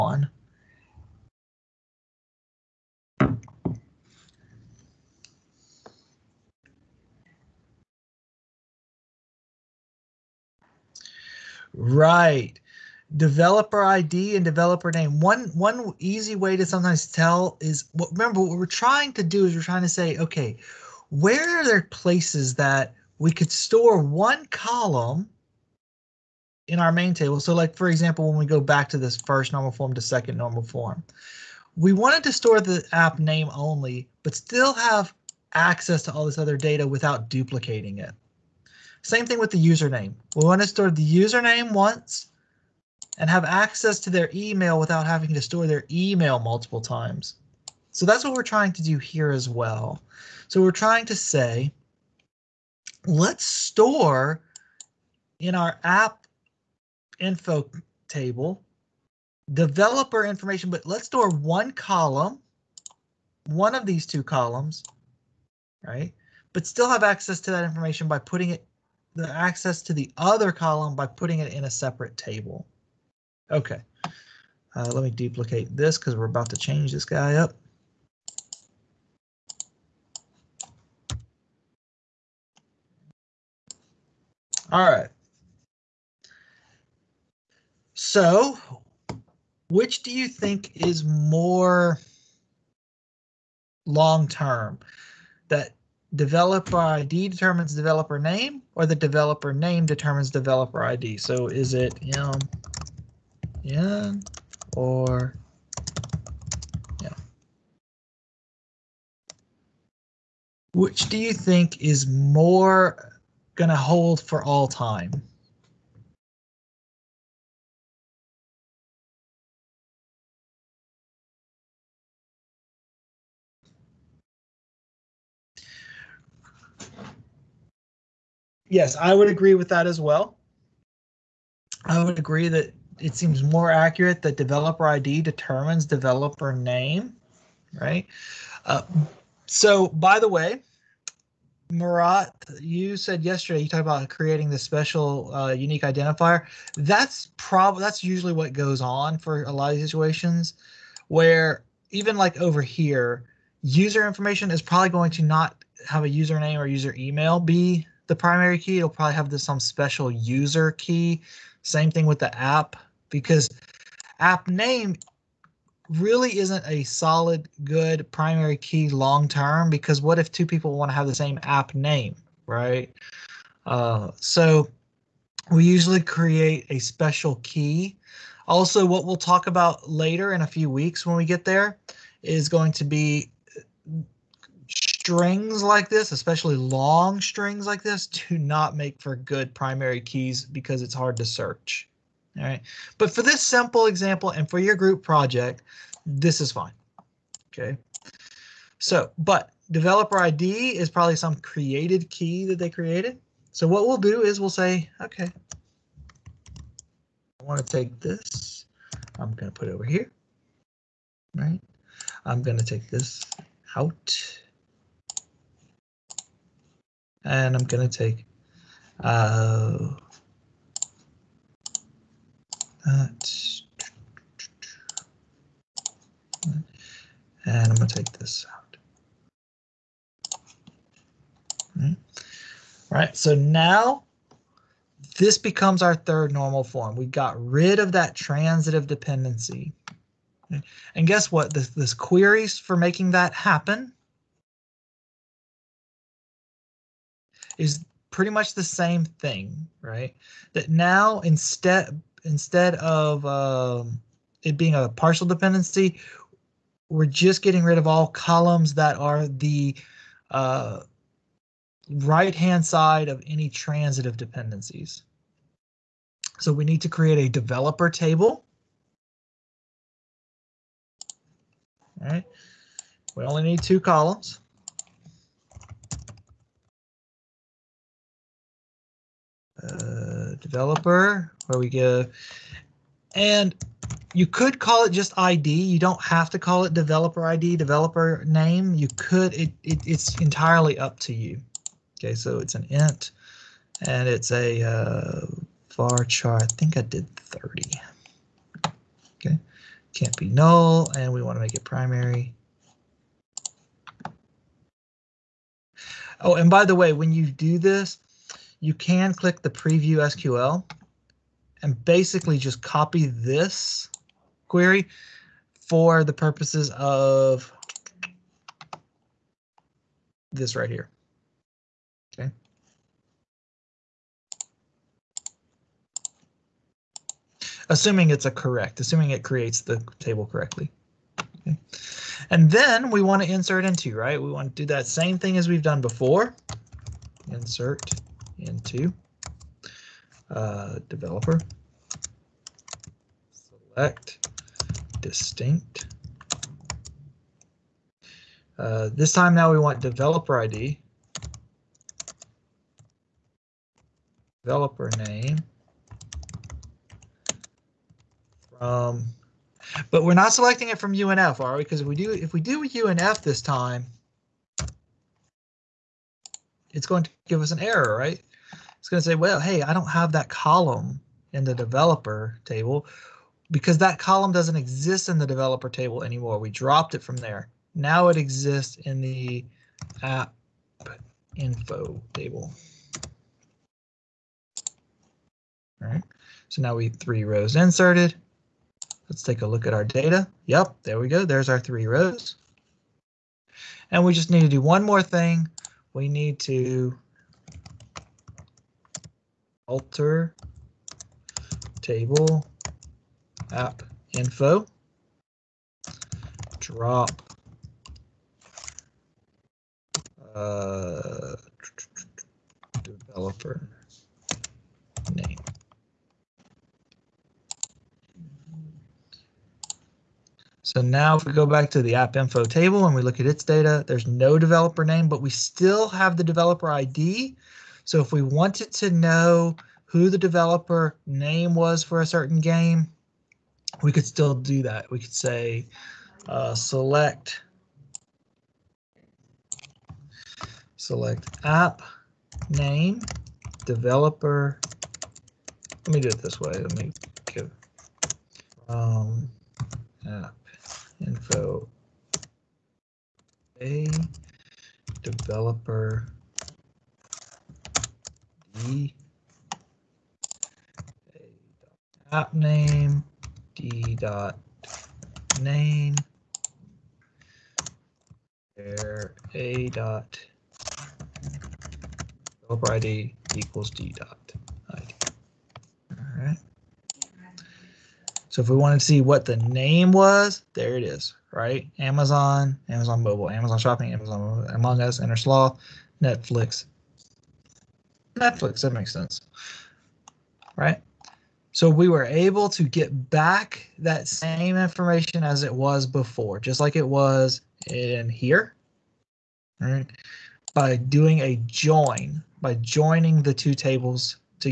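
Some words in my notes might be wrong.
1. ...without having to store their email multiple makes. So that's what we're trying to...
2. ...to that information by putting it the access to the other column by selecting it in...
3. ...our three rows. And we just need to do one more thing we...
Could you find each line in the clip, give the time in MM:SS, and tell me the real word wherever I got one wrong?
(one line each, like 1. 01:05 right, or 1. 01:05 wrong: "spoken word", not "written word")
1. 00:44 wrong: "times", not "makes"
2. 01:07 wrong: "putting", not "selecting"
3. 06:31 right.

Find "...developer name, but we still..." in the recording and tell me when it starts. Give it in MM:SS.
07:04.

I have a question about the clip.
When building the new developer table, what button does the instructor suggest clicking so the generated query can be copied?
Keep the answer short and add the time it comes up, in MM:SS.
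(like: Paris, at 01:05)
preview SQL, at 05:09.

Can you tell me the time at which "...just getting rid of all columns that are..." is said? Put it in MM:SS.
04:17.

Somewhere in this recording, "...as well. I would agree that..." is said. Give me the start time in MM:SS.
02:09.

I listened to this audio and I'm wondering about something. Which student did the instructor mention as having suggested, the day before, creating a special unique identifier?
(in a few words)
Murat.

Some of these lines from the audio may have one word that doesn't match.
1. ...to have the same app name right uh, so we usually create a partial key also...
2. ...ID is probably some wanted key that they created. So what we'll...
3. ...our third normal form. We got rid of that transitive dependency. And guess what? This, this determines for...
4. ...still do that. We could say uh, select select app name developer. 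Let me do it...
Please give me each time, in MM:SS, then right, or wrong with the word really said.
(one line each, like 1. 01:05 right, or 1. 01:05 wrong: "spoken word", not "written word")
1. 02:50 wrong: "special", not "partial"
2. 03:20 wrong: "created", not "wanted"
3. 03:55 wrong: "queries", not "determines"
4. 07:14 right.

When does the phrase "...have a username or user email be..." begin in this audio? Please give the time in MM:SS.
02:35.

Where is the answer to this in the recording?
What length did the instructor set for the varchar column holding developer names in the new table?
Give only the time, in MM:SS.
04:57.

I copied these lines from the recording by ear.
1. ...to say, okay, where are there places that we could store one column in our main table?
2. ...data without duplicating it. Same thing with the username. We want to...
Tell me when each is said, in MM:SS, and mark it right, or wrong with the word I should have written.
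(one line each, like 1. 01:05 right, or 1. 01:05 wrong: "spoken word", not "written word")
1. 00:19 right
2. 00:36 right.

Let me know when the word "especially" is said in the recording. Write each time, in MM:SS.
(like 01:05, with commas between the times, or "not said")
03:06.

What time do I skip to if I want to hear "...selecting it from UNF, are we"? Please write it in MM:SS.
06:00.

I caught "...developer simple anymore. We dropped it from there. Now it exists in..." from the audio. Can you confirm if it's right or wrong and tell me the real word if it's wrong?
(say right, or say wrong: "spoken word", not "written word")
wrong: "table", not "simple".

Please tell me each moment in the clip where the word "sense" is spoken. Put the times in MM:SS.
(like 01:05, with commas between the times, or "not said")
08:08.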